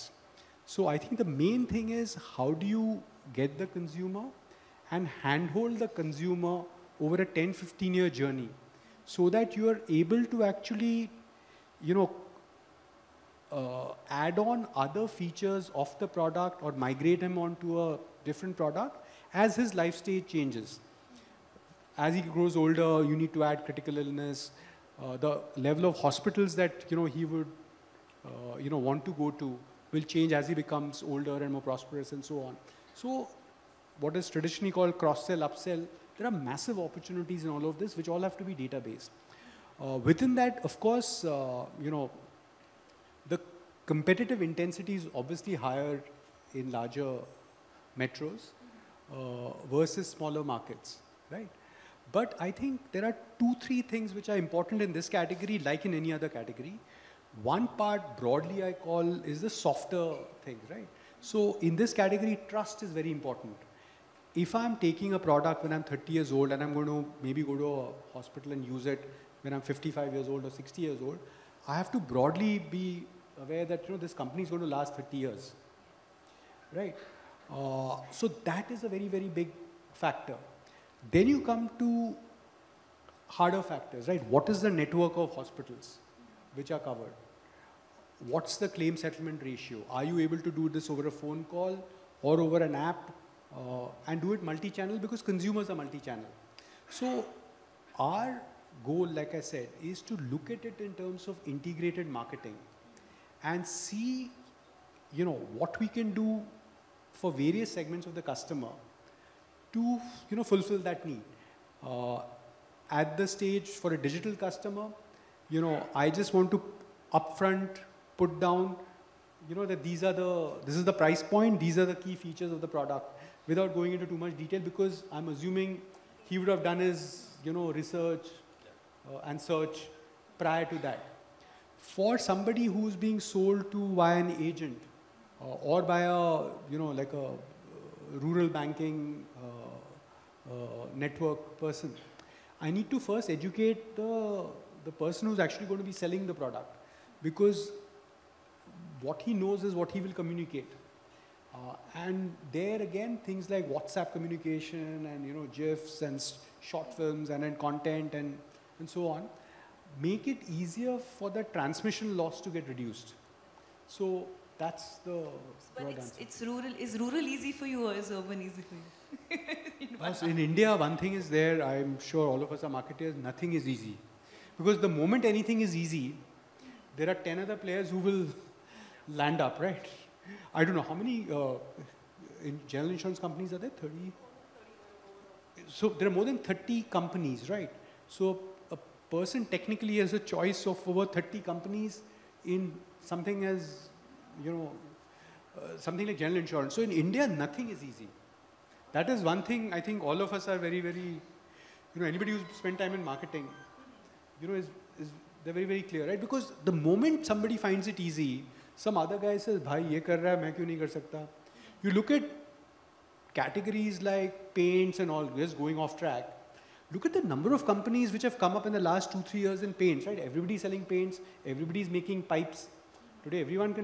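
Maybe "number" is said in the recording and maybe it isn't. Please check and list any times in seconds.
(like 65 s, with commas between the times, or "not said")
217 s.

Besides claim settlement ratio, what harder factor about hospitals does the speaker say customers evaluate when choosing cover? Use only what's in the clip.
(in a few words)
Network of hospitals.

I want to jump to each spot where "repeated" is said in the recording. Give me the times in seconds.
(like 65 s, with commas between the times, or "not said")
not said.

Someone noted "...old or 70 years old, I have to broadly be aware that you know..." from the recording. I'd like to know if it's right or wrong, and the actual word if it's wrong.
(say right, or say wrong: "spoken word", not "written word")
wrong: "60", not "70".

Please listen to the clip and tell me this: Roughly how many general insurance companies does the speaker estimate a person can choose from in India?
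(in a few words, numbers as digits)
More than 30.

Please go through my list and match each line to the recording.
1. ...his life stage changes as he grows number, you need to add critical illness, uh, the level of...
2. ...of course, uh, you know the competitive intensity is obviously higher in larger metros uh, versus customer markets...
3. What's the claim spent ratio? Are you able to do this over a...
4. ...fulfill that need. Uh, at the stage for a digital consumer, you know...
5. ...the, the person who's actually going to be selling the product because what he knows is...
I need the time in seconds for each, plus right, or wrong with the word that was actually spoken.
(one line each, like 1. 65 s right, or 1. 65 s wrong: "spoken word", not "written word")
1. 19 s wrong: "older", not "number"
2. 40 s wrong: "smaller", not "customer"
3. 88 s wrong: "settlement", not "spent"
4. 110 s wrong: "customer", not "consumer"
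5. 143 s right.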